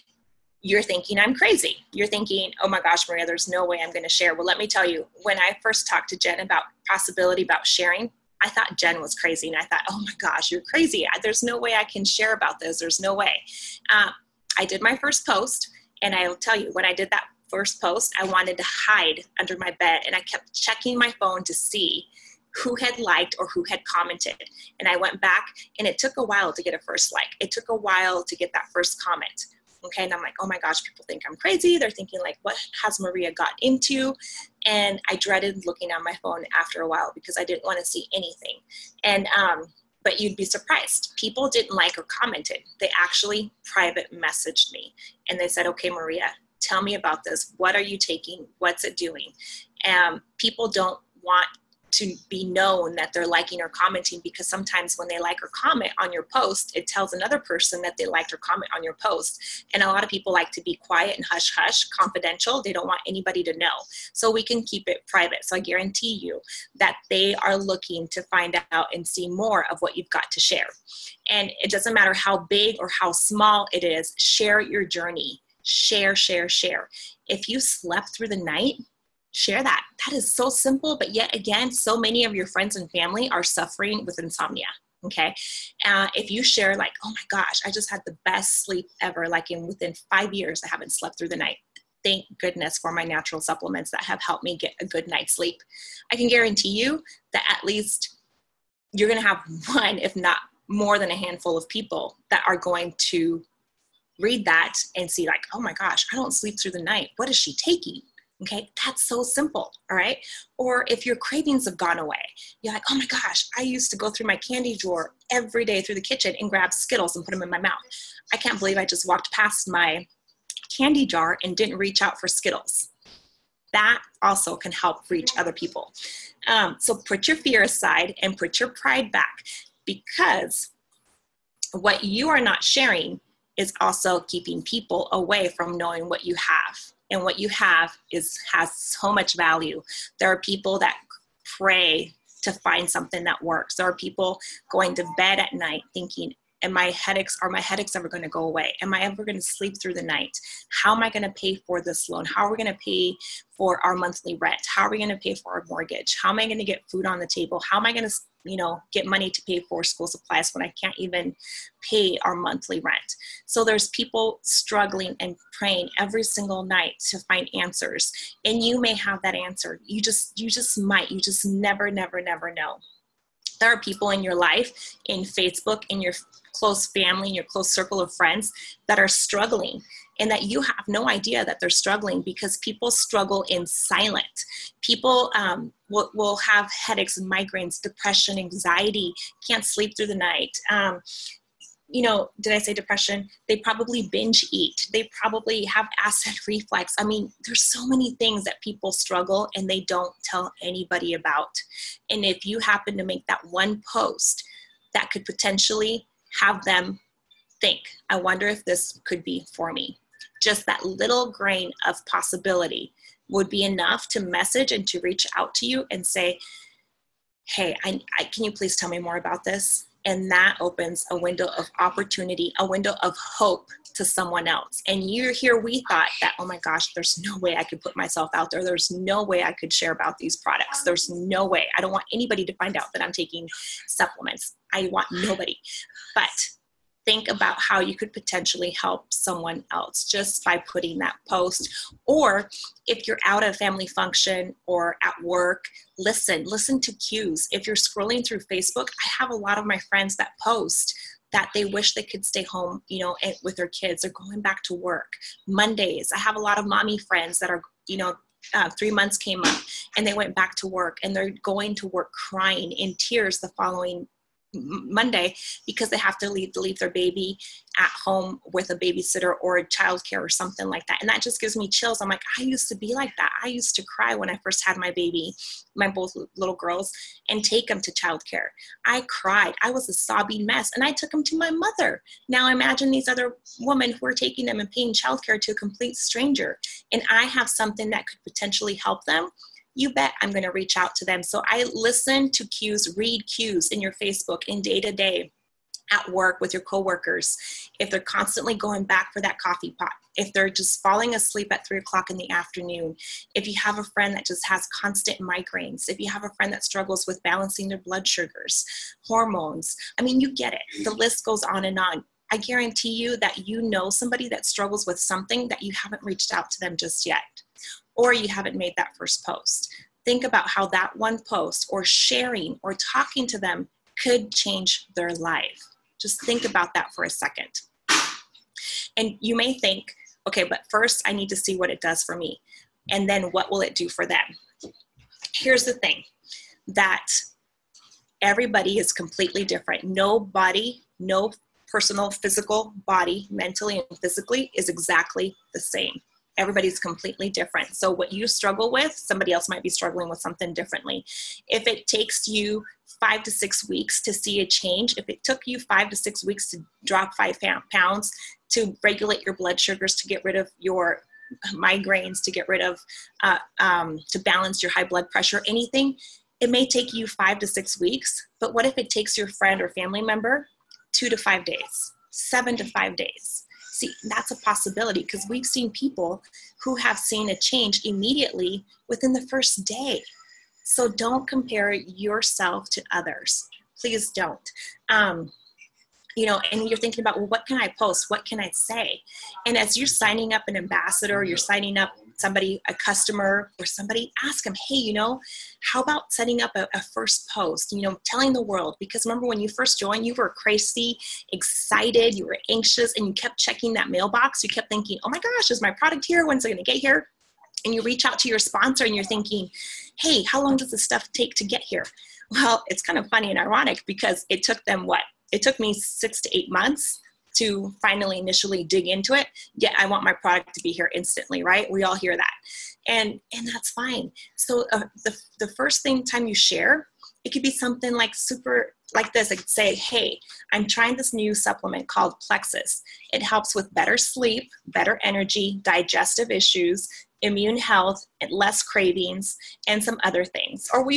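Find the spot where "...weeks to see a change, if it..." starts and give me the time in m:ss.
5:53.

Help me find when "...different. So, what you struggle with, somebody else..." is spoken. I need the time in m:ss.
5:47.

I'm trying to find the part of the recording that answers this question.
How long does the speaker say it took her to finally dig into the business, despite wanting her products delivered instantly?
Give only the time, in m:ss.
6:55.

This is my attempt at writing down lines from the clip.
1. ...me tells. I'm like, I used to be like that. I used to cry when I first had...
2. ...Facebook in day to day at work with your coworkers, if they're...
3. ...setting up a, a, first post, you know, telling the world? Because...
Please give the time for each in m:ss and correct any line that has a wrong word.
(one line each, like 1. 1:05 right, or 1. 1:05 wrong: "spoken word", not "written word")
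1. 4:31 wrong: "chills", not "tells"
2. 4:54 right
3. 6:36 right.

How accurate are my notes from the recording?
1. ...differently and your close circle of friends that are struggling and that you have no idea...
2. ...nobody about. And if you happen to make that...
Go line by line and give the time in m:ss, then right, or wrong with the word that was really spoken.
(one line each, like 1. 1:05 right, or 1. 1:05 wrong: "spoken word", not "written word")
1. 2:56 wrong: "family", not "differently"
2. 3:20 wrong: "anybody", not "nobody".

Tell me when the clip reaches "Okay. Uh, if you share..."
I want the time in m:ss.
1:25.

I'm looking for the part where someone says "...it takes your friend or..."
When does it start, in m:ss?
6:08.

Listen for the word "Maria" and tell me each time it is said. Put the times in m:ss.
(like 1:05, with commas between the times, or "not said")
0:03, 0:32, 0:45.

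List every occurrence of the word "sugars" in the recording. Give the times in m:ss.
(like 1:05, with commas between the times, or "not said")
5:08, 5:59.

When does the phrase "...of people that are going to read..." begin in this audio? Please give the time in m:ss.
1:41.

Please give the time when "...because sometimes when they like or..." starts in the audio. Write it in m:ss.
0:54.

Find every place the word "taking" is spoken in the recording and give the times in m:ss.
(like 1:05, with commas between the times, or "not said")
0:47, 1:47, 3:53, 4:44.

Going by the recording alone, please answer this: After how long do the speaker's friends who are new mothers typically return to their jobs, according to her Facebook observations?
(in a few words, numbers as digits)
3 months.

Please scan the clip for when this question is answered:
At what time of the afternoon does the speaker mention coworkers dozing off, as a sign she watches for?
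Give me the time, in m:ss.
5:01.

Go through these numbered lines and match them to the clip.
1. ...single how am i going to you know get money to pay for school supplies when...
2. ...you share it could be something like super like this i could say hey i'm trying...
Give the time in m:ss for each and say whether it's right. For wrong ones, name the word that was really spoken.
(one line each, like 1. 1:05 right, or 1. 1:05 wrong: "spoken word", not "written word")
1. 2:37 wrong: "table", not "single"
2. 7:06 right.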